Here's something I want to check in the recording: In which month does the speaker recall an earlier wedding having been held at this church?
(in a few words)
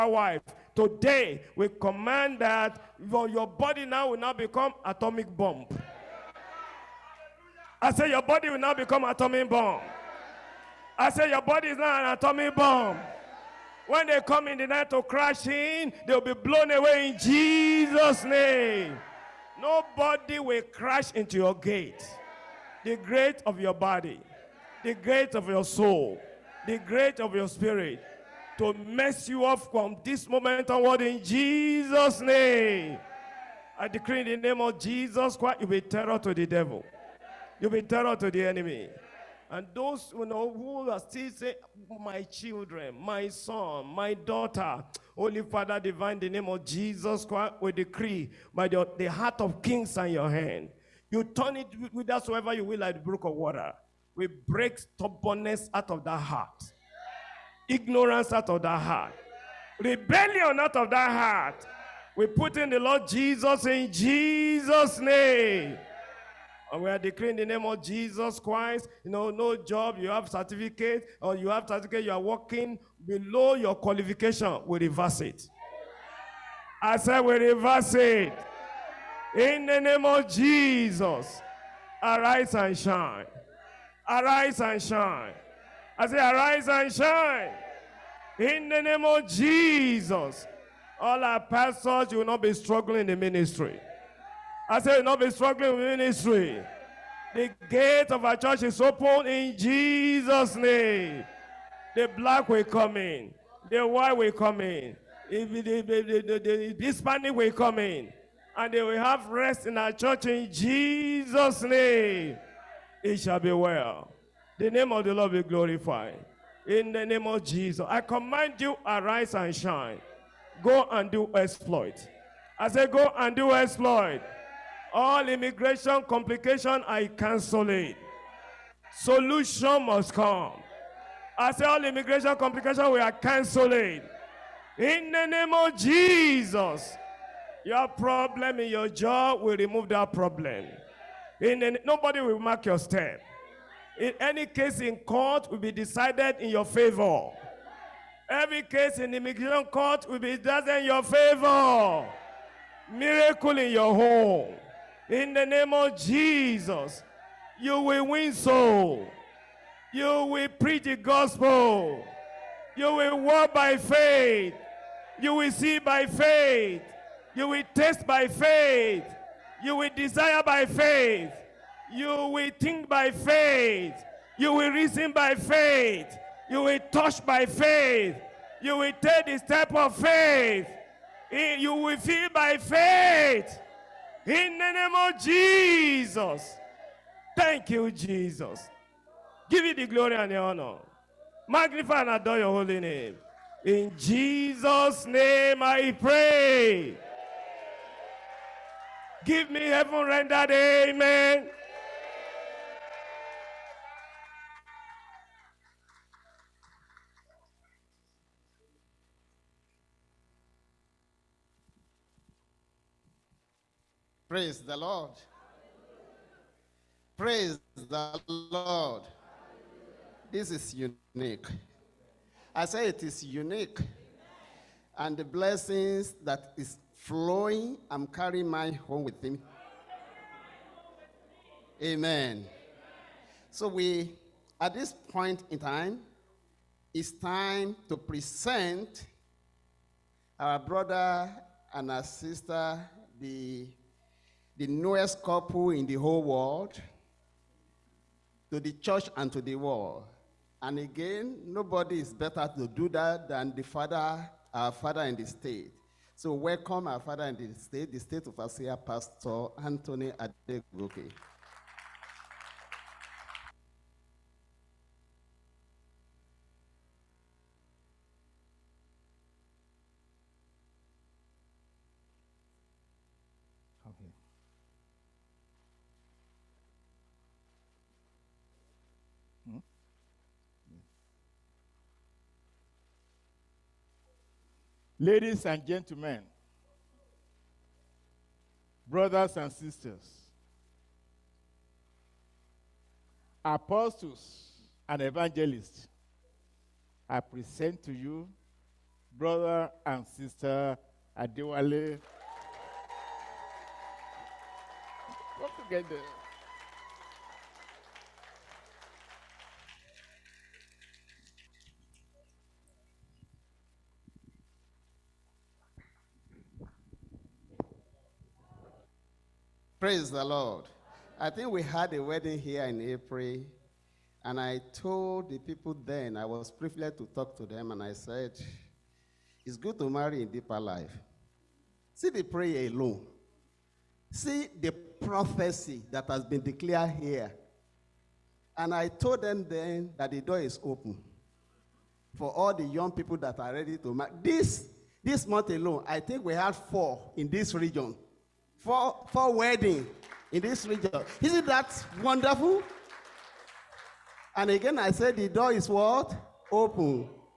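April.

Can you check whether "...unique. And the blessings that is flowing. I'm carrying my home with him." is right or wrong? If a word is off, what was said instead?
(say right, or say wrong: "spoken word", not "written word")
right.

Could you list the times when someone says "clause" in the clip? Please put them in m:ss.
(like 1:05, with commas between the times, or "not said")
not said.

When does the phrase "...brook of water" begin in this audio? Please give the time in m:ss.
0:53.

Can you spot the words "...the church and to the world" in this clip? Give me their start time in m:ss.
4:08.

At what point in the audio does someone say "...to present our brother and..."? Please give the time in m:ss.
3:57.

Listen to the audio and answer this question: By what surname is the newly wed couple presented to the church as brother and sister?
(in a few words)
Adewale.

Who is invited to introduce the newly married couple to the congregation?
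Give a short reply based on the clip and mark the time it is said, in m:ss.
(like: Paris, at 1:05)
Pastor Anthony Adegoke, at 4:18.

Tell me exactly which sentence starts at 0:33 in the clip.
I decree in the name of Jesus Christ, you'll be terror to the devil.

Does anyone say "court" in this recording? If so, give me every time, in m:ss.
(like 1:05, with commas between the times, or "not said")
2:24, 2:29.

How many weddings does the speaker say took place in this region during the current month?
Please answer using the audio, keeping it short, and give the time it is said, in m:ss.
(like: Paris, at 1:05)
4, at 5:46.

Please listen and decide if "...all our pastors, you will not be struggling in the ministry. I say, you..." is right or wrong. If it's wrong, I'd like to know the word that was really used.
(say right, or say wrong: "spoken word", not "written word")
right.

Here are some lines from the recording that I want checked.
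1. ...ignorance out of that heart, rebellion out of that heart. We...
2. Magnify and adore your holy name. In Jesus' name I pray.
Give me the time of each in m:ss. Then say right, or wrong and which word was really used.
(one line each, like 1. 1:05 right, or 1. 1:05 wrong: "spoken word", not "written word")
1. 0:57 right
2. 3:11 right.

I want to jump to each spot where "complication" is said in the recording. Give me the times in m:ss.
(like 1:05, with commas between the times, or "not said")
2:06, 2:12.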